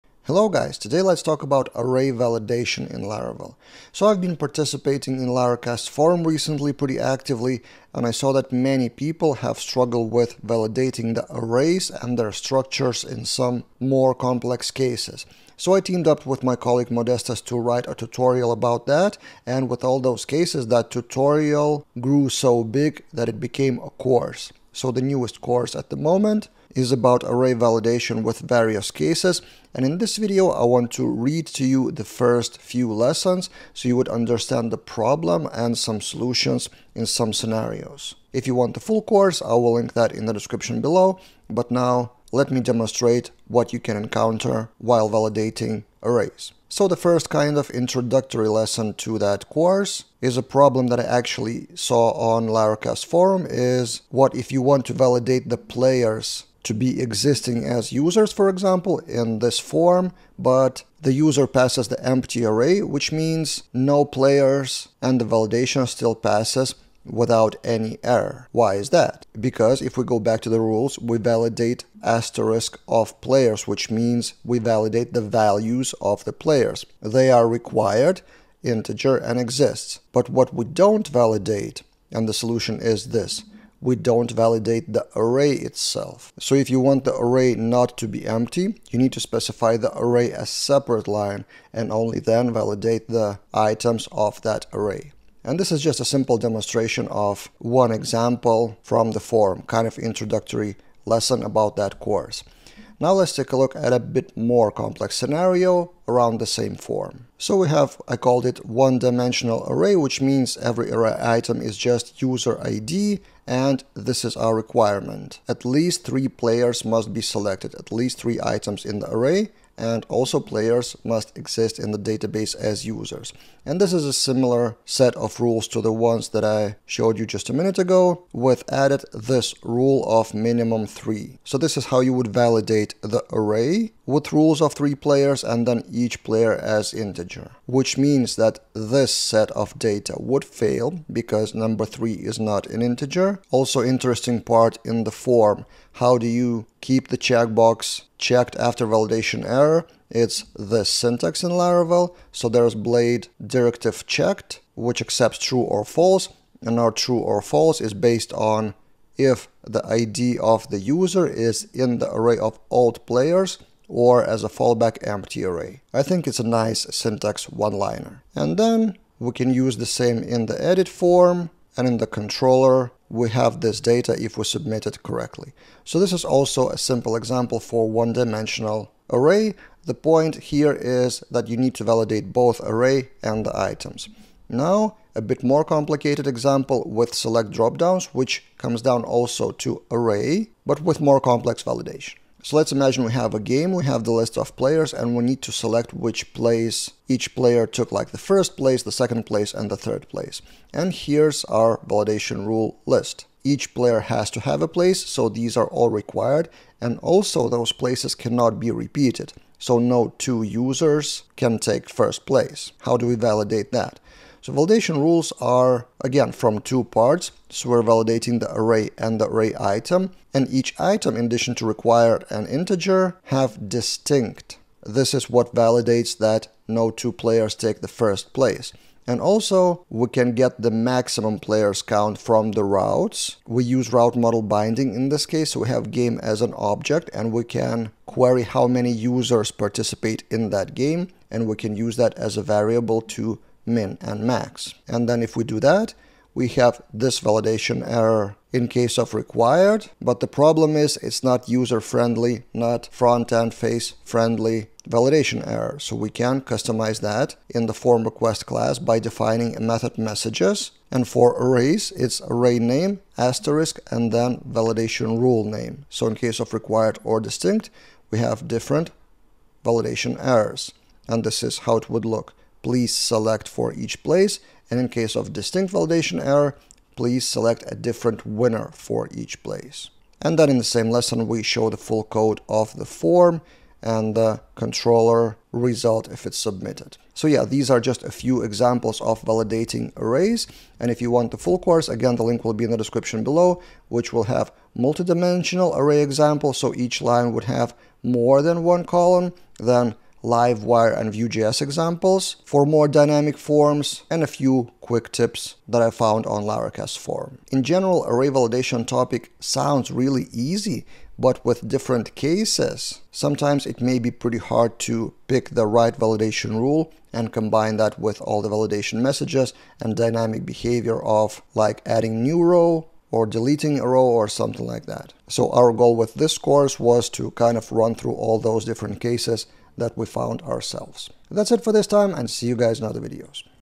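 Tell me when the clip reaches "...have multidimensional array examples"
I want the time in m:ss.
4:54.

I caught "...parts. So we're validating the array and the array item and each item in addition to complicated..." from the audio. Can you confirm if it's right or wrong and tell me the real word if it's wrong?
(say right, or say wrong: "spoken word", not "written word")
wrong: "required", not "complicated".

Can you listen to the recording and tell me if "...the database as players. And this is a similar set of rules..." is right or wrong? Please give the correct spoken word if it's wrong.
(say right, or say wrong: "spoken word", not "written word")
wrong: "users", not "players".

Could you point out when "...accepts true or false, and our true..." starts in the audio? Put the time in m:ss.
2:35.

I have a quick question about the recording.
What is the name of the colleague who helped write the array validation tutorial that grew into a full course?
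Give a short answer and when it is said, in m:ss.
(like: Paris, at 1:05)
Modestas, at 0:16.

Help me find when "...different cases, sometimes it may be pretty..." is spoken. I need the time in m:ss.
5:11.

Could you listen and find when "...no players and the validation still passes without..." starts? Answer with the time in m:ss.
1:03.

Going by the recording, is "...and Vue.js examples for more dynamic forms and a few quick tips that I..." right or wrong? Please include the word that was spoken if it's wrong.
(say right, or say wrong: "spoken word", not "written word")
right.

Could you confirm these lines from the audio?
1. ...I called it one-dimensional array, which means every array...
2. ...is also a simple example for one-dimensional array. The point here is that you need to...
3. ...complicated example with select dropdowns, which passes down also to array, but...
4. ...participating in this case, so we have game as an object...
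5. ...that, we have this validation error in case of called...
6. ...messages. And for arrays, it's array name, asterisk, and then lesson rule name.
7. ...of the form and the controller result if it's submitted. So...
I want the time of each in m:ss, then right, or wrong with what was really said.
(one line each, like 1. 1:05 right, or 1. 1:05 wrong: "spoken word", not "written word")
1. 1:48 right
2. 2:56 right
3. 3:05 wrong: "comes", not "passes"
4. 3:54 wrong: "binding", not "participating"
5. 4:05 wrong: "required", not "called"
6. 4:19 wrong: "validation", not "lesson"
7. 4:42 right.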